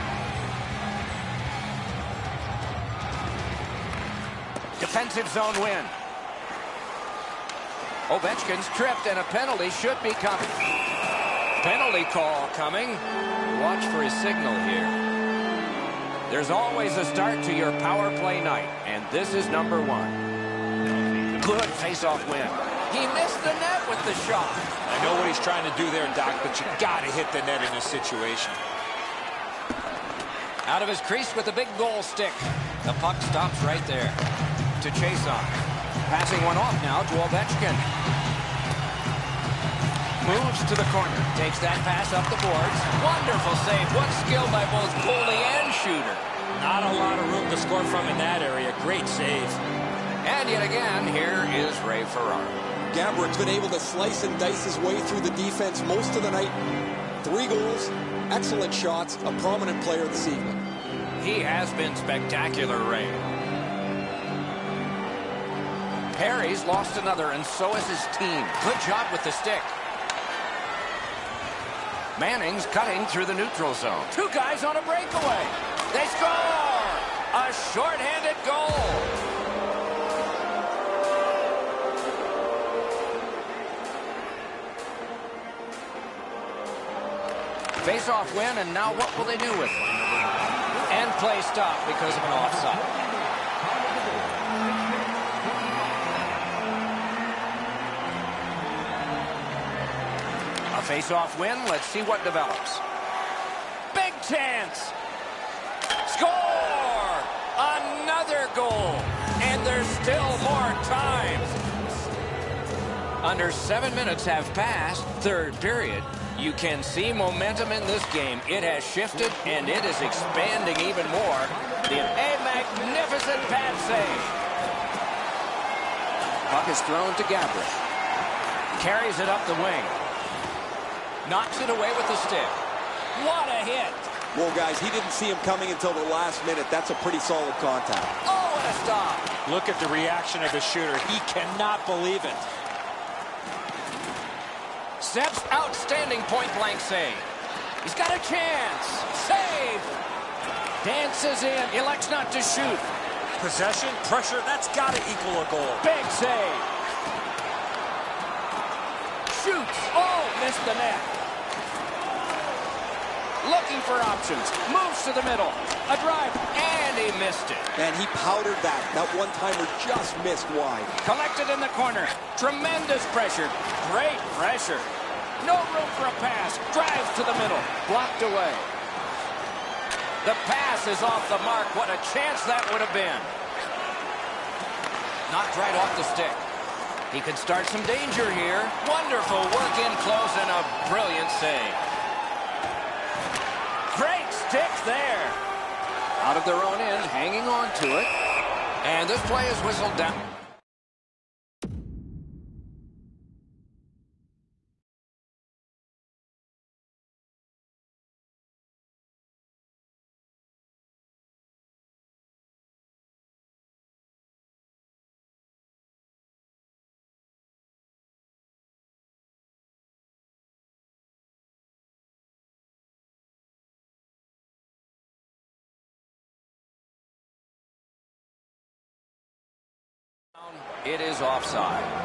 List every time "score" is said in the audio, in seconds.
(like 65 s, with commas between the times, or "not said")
47 s, 76 s, 106 s.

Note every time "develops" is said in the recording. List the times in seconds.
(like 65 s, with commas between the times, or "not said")
102 s.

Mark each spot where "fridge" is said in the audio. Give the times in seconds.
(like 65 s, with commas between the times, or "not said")
not said.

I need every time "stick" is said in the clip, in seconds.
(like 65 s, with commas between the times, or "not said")
32 s, 69 s, 132 s, 186 s, 194 s.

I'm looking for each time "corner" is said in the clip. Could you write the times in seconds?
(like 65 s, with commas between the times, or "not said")
40 s, 171 s.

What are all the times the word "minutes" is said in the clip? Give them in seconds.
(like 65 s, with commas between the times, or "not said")
113 s, 136 s.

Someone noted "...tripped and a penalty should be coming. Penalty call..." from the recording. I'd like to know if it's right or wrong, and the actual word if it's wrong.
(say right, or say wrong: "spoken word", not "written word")
right.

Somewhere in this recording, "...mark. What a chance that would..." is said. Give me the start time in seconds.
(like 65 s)
181 s.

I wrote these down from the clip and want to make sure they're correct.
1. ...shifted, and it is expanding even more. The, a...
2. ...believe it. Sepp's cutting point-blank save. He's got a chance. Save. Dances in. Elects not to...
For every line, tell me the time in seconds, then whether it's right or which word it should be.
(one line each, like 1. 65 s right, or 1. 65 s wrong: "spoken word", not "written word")
1. 118 s right
2. 141 s wrong: "outstanding", not "cutting".